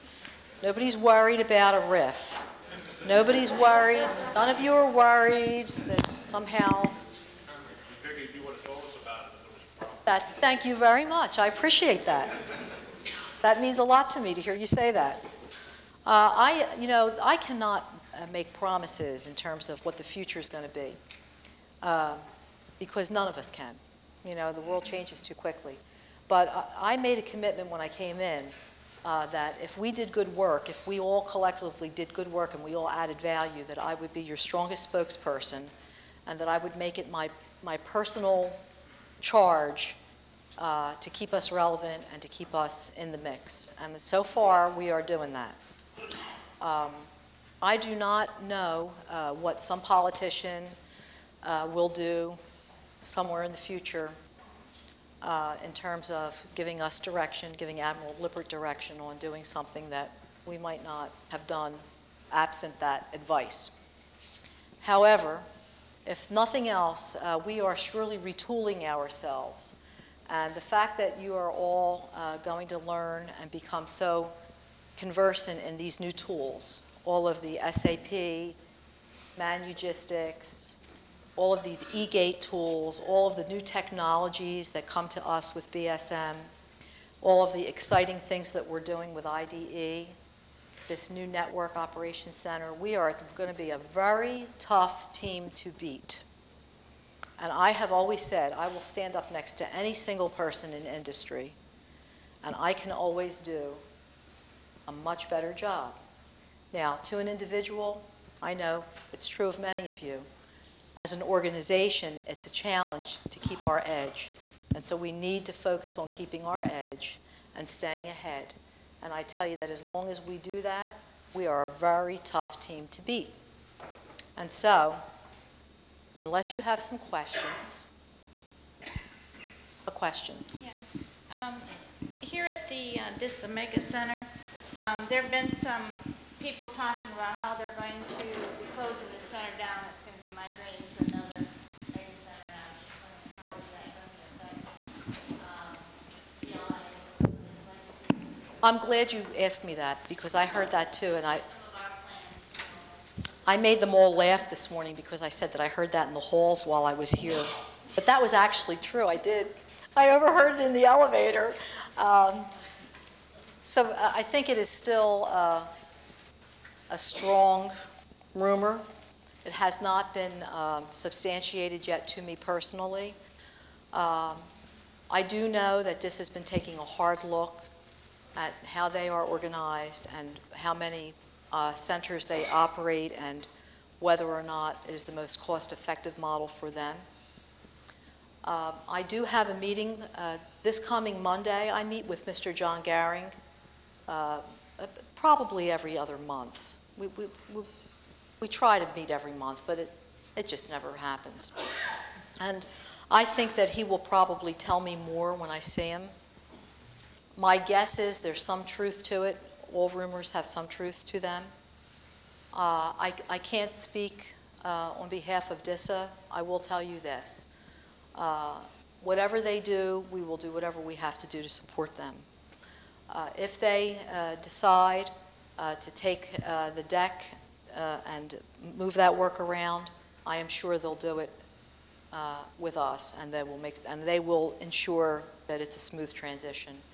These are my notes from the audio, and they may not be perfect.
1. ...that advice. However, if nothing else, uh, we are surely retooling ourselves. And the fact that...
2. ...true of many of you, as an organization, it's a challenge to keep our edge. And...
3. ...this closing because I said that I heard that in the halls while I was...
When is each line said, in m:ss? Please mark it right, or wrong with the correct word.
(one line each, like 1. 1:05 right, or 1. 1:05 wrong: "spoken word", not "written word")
1. 1:02 right
2. 1:49 right
3. 2:34 wrong: "morning", not "closing".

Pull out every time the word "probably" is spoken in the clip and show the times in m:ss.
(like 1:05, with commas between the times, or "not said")
3:15, 3:23.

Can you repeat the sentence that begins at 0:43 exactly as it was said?
And so far, we are doing that.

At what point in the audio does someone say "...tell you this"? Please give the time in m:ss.
3:36.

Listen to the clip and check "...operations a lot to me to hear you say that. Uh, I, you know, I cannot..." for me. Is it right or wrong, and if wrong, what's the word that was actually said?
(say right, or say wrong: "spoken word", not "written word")
wrong: "means", not "operations".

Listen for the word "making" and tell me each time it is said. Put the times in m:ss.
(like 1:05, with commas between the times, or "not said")
not said.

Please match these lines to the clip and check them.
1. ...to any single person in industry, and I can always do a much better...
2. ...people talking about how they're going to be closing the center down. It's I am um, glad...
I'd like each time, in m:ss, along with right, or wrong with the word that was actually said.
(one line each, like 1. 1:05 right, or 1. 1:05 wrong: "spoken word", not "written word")
1. 1:39 right
2. 2:16 right.